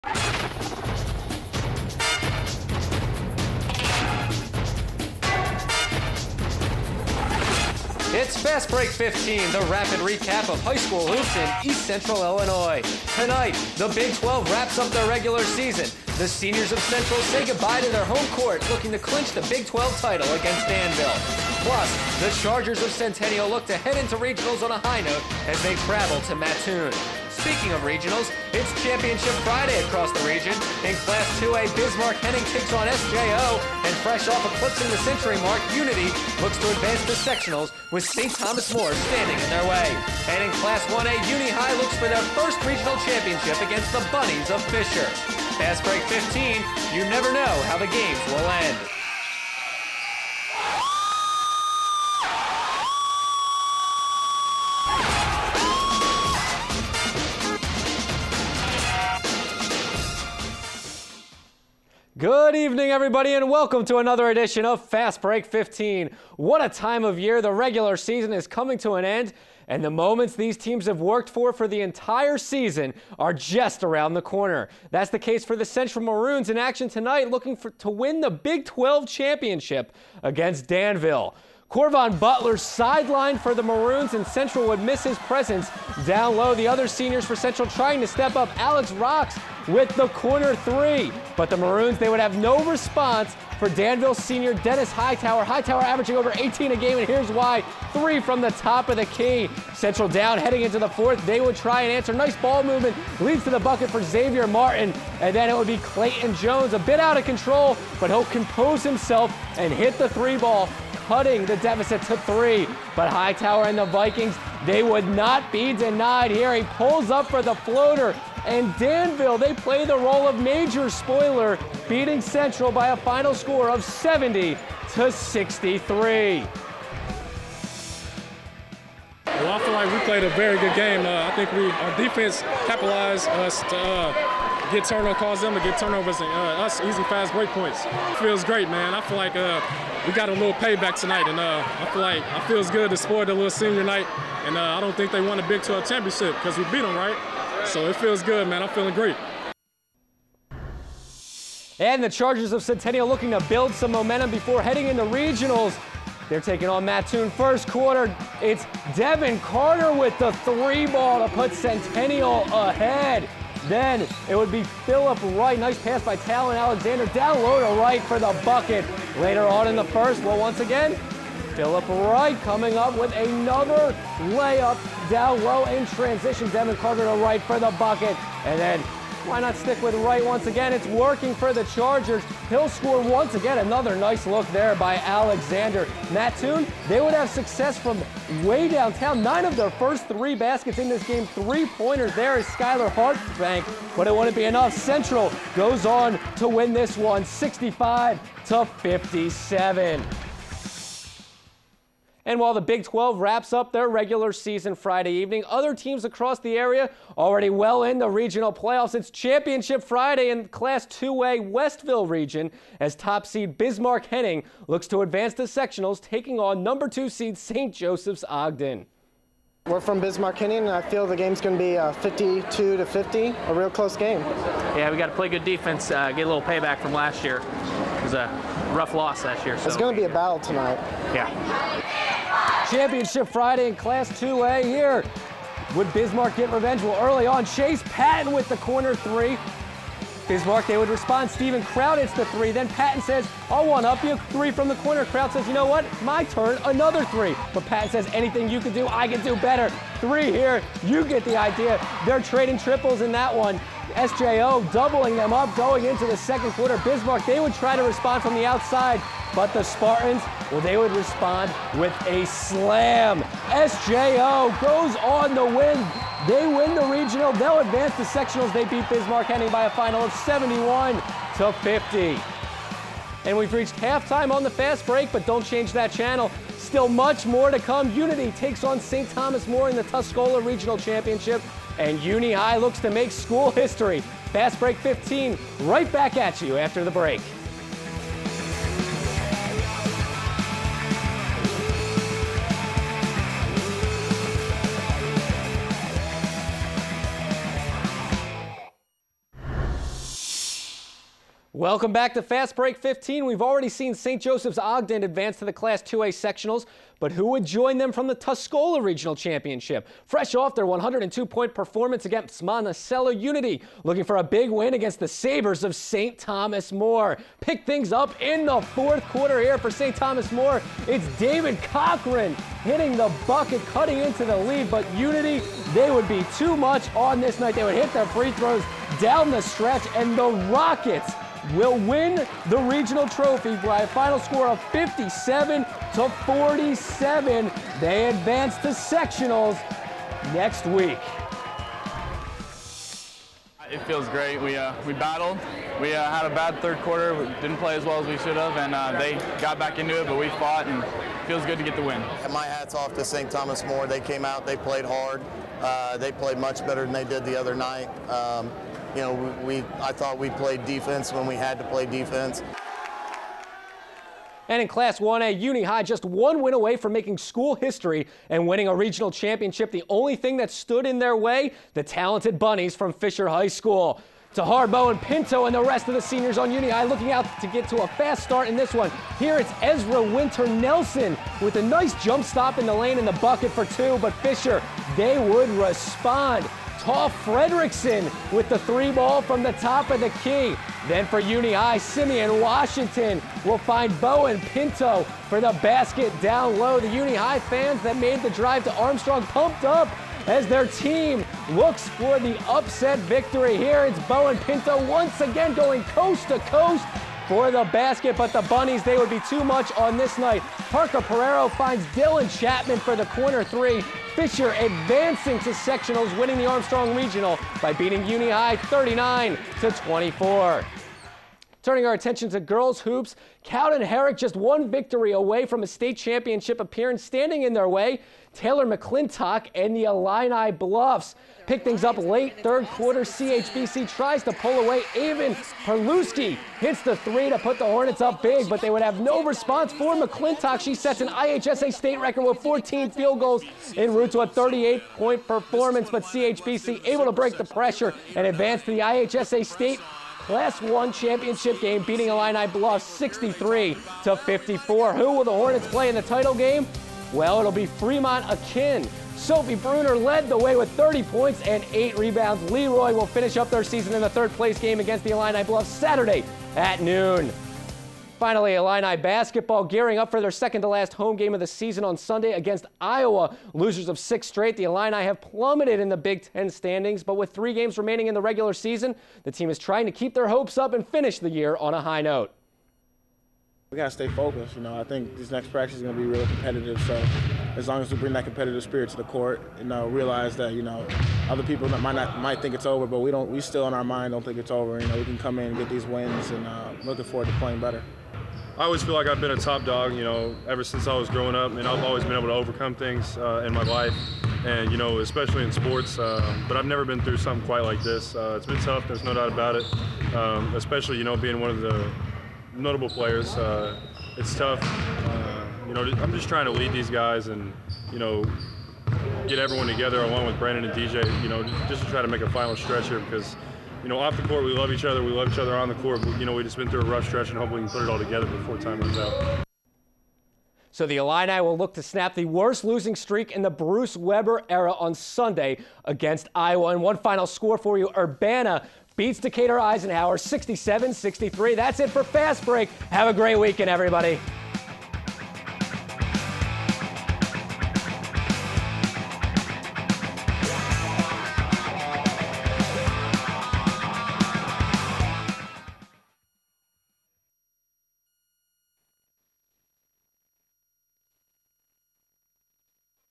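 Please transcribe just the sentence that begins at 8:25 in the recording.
Um, but I've never been through something quite like this.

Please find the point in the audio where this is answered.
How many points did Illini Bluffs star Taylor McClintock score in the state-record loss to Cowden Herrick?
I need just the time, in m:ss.
7:24.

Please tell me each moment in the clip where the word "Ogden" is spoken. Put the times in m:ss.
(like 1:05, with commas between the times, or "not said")
3:38, 5:04.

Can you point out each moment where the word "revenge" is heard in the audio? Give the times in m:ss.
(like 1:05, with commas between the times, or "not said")
3:56.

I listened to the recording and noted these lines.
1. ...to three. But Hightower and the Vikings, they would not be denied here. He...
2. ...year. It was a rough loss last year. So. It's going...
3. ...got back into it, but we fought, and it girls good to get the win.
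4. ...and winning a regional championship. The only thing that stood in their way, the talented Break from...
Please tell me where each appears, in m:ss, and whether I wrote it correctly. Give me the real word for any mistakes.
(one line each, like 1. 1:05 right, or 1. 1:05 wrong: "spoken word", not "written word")
1. 1:52 right
2. 3:47 right
3. 5:49 wrong: "feels", not "girls"
4. 6:08 wrong: "Bunnies", not "Break".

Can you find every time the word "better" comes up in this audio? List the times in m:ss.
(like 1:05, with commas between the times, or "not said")
4:09, 5:56, 8:17.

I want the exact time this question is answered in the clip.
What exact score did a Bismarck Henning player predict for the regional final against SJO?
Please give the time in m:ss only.
3:41.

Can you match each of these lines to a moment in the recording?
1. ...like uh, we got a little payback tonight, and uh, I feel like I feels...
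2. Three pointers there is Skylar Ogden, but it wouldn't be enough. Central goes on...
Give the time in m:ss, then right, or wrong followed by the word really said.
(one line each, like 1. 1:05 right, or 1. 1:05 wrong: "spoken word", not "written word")
1. 2:19 right
2. 3:11 wrong: "Hartbank", not "Ogden".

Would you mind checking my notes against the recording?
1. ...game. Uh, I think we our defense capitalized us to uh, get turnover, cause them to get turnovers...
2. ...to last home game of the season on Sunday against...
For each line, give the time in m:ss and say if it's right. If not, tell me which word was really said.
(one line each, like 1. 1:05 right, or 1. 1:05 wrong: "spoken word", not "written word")
1. 2:10 right
2. 7:50 right.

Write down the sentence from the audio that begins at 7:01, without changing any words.
Turning our attention to girls hoops, Cowden Herrick just one victory away from a state championship appearance.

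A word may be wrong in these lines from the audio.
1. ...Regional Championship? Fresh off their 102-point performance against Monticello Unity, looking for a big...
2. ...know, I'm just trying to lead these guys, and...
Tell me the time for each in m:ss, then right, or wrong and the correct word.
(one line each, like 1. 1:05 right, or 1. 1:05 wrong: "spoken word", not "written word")
1. 5:08 right
2. 8:35 right.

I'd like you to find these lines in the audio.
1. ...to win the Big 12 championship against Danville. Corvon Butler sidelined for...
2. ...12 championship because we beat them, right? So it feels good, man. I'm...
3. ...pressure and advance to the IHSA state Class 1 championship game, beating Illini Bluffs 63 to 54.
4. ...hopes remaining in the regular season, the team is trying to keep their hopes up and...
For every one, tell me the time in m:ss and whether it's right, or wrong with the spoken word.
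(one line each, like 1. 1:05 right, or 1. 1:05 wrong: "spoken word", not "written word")
1. 1:17 right
2. 2:25 right
3. 7:27 right
4. 7:57 wrong: "games", not "hopes".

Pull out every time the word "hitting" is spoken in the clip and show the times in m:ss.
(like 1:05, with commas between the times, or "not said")
5:22.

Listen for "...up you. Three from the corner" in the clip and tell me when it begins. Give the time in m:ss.
4:03.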